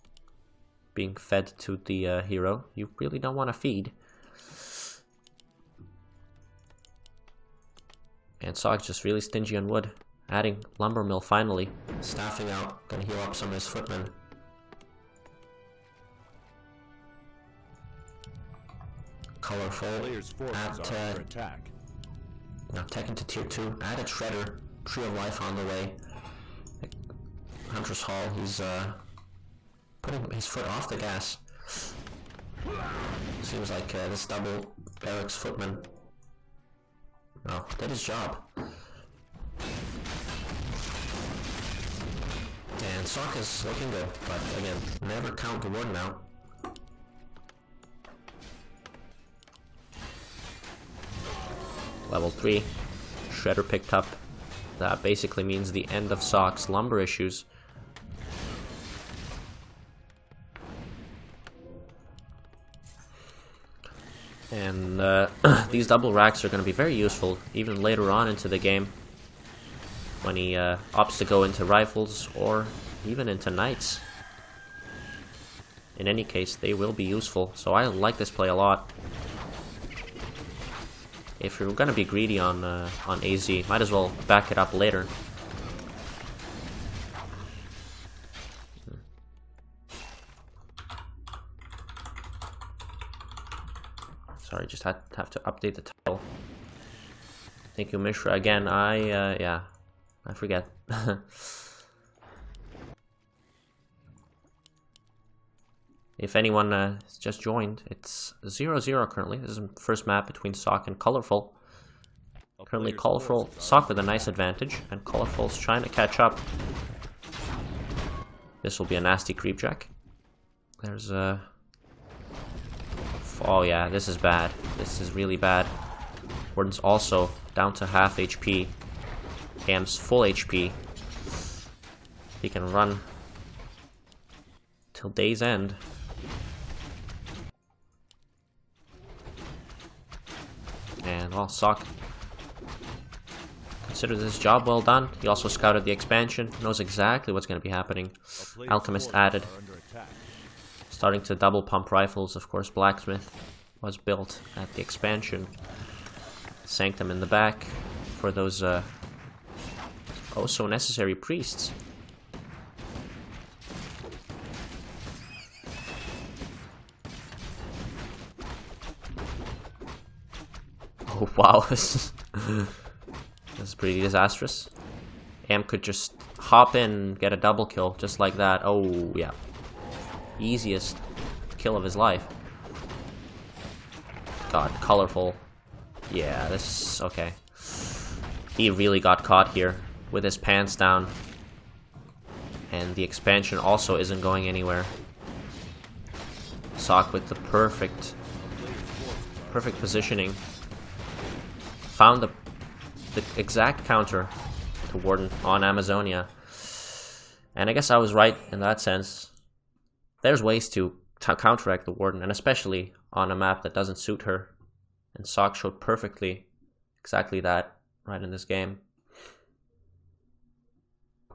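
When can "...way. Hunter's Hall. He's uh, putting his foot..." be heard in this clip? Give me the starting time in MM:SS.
00:25.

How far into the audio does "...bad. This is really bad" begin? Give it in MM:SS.
02:04.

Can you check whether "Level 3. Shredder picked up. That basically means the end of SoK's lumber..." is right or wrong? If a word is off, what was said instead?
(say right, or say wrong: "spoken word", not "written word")
right.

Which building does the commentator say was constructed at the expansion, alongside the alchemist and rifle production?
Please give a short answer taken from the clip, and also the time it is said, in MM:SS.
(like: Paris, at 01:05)
Blacksmith, at 02:32.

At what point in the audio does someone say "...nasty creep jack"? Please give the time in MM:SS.
01:59.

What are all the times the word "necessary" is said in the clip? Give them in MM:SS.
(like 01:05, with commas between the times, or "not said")
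02:40.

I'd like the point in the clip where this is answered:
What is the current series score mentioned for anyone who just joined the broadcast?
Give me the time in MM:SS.
01:48.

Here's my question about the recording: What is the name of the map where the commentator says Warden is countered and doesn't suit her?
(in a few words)
Amazonia.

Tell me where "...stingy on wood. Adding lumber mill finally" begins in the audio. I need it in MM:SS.
00:09.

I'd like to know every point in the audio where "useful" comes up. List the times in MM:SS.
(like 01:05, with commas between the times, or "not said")
01:06, 01:17.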